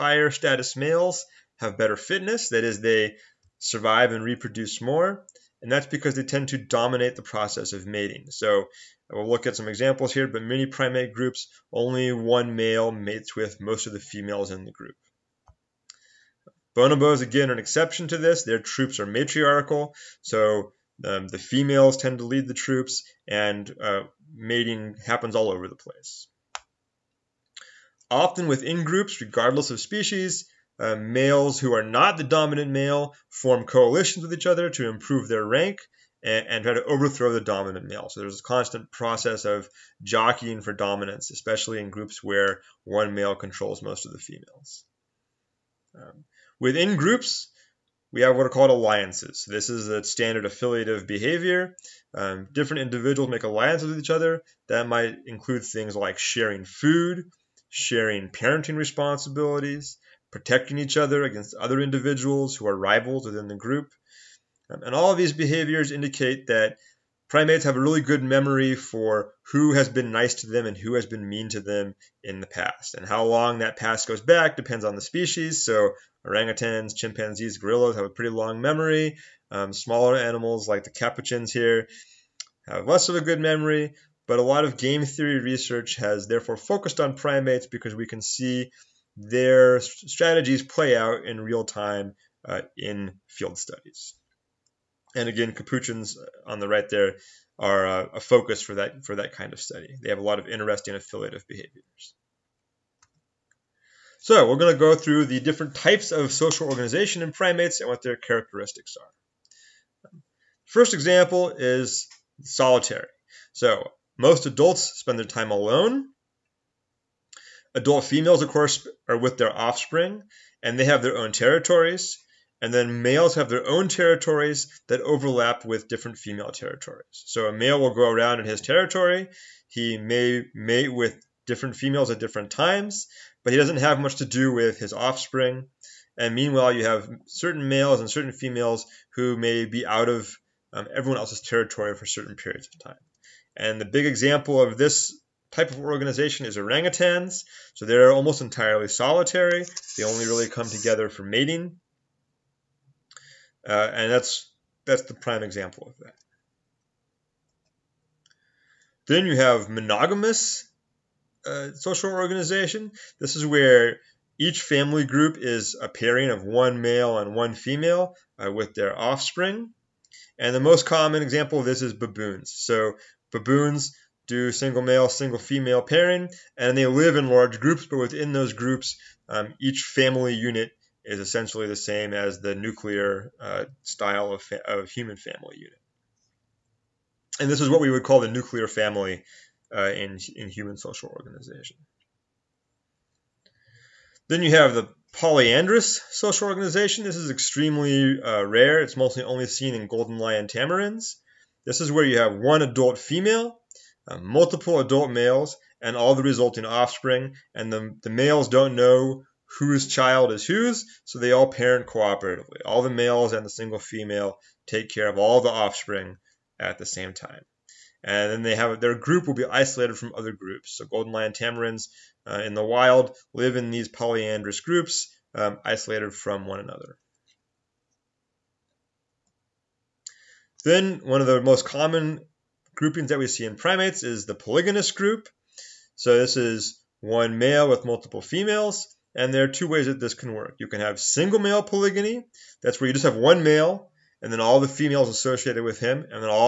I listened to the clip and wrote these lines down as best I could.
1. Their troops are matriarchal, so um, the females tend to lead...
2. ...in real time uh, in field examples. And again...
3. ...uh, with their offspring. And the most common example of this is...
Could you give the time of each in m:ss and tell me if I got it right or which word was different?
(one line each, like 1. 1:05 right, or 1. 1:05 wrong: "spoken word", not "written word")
1. 0:18 right
2. 1:31 wrong: "studies", not "examples"
3. 2:48 right.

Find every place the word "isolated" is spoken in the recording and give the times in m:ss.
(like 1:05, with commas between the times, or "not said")
3:39, 3:45.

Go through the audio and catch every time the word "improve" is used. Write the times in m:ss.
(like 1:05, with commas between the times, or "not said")
0:34.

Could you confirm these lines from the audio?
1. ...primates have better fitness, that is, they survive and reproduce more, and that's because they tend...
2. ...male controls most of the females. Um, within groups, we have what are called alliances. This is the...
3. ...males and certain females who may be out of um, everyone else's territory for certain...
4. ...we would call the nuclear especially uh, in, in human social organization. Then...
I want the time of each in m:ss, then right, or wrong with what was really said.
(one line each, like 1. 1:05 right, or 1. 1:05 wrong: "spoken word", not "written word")
1. 0:00 wrong: "males", not "primates"
2. 0:43 right
3. 2:17 right
4. 3:07 wrong: "family", not "especially".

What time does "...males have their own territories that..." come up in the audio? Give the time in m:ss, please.
2:03.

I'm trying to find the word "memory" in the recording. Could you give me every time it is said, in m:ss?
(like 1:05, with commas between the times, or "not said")
1:08, 1:18, 1:23.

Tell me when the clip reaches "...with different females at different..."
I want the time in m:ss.
2:10.